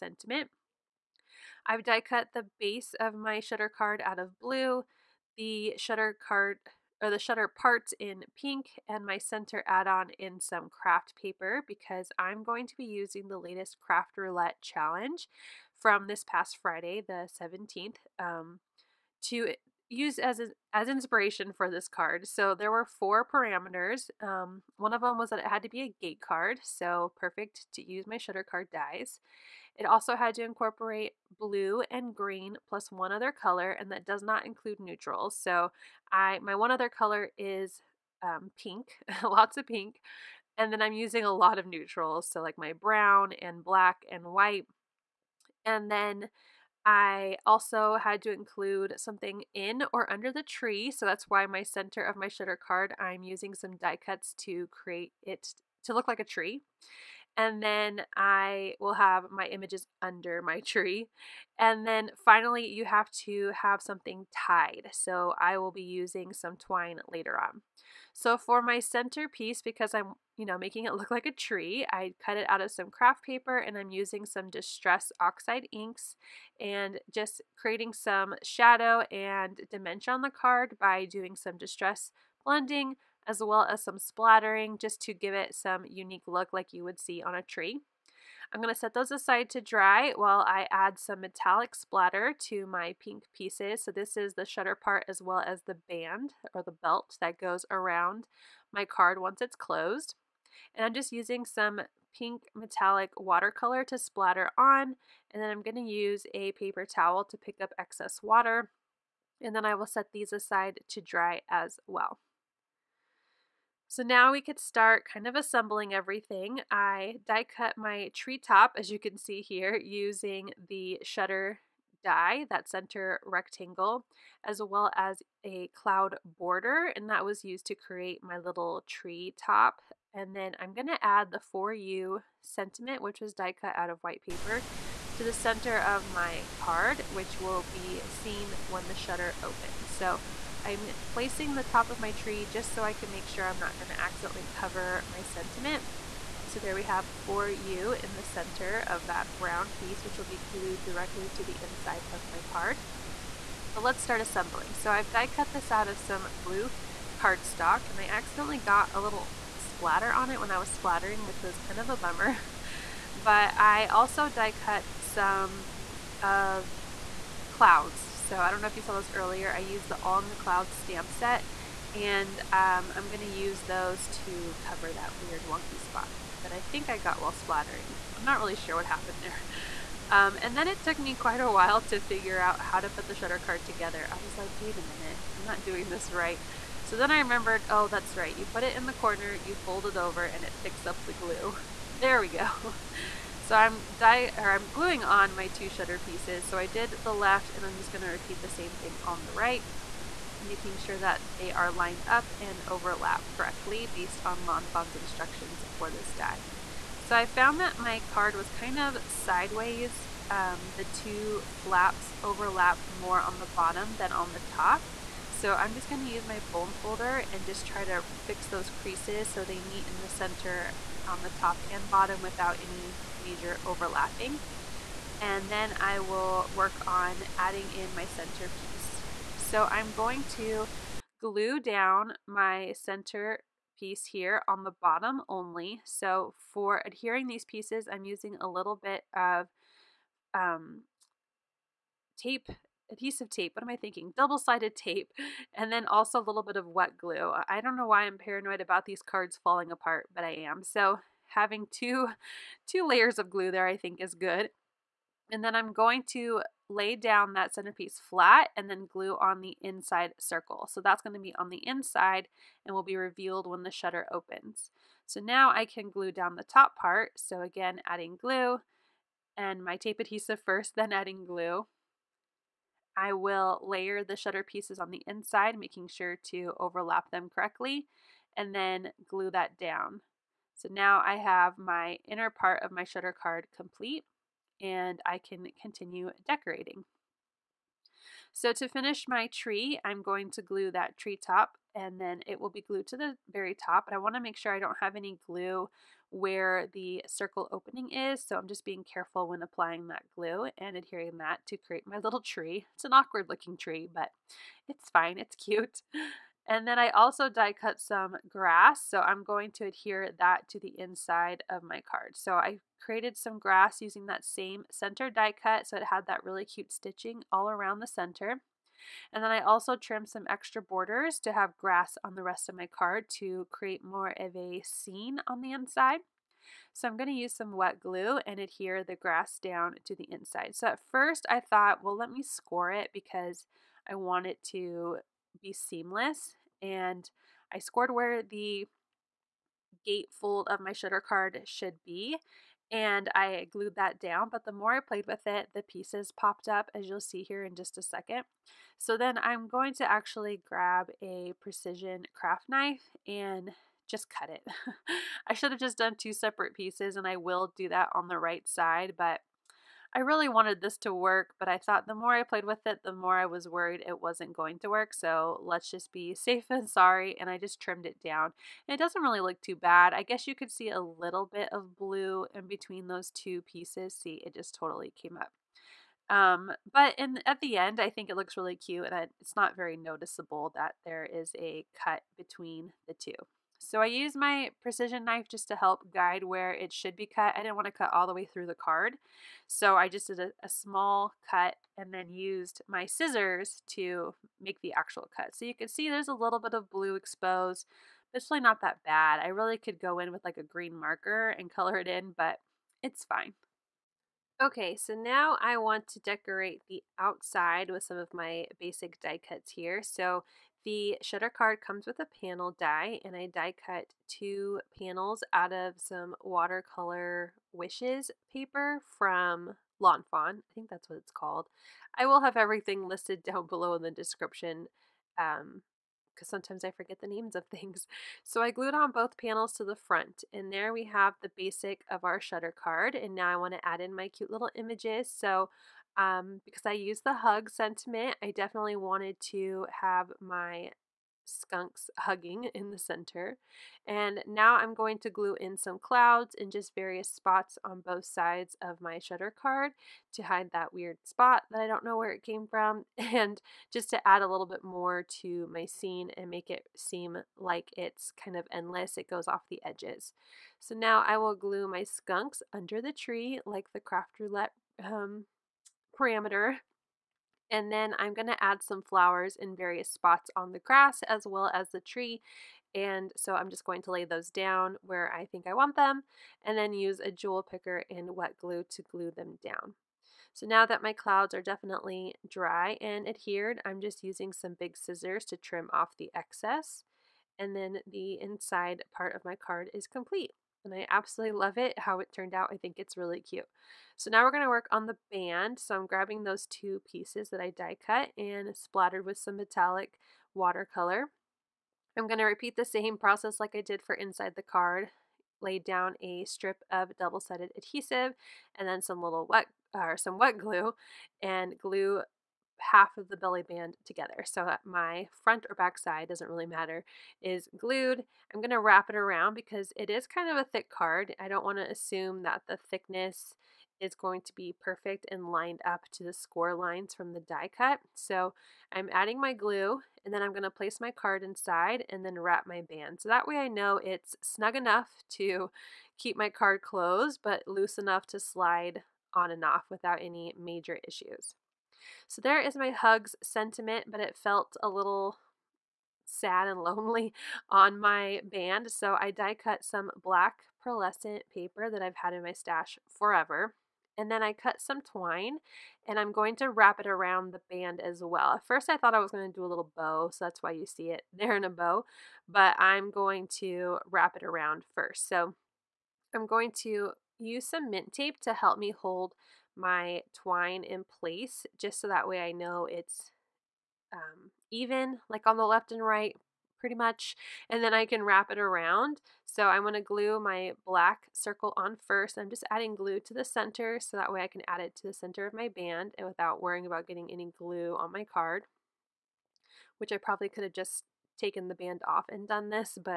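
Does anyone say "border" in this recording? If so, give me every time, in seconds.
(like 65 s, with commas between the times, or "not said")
126 s, 320 s.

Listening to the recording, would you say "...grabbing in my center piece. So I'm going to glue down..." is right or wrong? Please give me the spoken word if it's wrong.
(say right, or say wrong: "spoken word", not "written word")
wrong: "adding", not "grabbing".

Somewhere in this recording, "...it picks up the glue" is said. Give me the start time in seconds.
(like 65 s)
190 s.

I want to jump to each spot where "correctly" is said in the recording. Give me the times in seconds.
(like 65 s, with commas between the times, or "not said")
203 s, 277 s.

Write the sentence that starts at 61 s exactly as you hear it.
And then finally, you have to have something tied.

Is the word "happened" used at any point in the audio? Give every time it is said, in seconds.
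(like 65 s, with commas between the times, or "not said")
178 s.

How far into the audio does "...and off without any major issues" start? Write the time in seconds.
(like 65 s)
539 s.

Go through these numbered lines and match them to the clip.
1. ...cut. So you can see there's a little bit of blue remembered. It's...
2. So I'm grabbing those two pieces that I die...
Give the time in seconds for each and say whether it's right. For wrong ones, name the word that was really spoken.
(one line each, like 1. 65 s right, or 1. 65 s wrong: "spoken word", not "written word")
1. 395 s wrong: "exposed", not "remembered"
2. 495 s right.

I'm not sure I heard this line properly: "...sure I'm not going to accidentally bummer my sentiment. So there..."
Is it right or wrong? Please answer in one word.
wrong.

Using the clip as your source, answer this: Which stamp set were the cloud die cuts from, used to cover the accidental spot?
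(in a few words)
On the Cloud.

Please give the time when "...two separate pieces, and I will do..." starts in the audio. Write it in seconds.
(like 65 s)
355 s.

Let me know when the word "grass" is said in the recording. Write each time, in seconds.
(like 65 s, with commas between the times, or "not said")
308 s, 313 s, 321 s, 328 s, 470 s.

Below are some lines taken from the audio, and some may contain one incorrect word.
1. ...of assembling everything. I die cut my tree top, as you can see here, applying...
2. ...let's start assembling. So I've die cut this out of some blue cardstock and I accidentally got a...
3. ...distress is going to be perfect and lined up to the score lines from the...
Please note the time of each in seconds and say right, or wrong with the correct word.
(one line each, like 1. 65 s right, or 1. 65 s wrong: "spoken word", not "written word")
1. 115 s wrong: "using", not "applying"
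2. 153 s right
3. 522 s wrong: "thickness", not "distress".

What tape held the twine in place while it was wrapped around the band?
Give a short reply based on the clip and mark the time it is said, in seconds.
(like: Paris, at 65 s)
Mint tape, at 567 s.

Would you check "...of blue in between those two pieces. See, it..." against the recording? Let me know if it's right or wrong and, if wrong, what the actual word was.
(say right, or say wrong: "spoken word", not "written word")
right.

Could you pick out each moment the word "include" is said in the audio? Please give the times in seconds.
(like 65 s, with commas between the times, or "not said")
34 s, 48 s.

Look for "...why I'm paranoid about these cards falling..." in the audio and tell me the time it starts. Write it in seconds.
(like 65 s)
247 s.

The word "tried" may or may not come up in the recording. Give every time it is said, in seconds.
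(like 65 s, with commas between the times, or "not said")
not said.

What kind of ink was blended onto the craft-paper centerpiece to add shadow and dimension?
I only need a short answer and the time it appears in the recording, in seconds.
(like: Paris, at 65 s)
Distress Oxide, at 74 s.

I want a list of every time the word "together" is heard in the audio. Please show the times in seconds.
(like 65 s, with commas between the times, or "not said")
183 s, 513 s.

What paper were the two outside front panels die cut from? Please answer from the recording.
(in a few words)
Watercolor Wishes.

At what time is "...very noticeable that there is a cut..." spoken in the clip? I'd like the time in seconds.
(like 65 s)
379 s.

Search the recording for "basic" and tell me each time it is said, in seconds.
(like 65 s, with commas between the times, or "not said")
408 s, 431 s.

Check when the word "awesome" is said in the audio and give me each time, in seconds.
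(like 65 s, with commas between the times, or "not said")
not said.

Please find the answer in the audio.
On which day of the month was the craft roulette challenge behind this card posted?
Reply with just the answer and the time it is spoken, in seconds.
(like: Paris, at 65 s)
17th, at 17 s.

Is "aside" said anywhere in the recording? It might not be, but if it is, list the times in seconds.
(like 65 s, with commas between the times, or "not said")
89 s, 110 s.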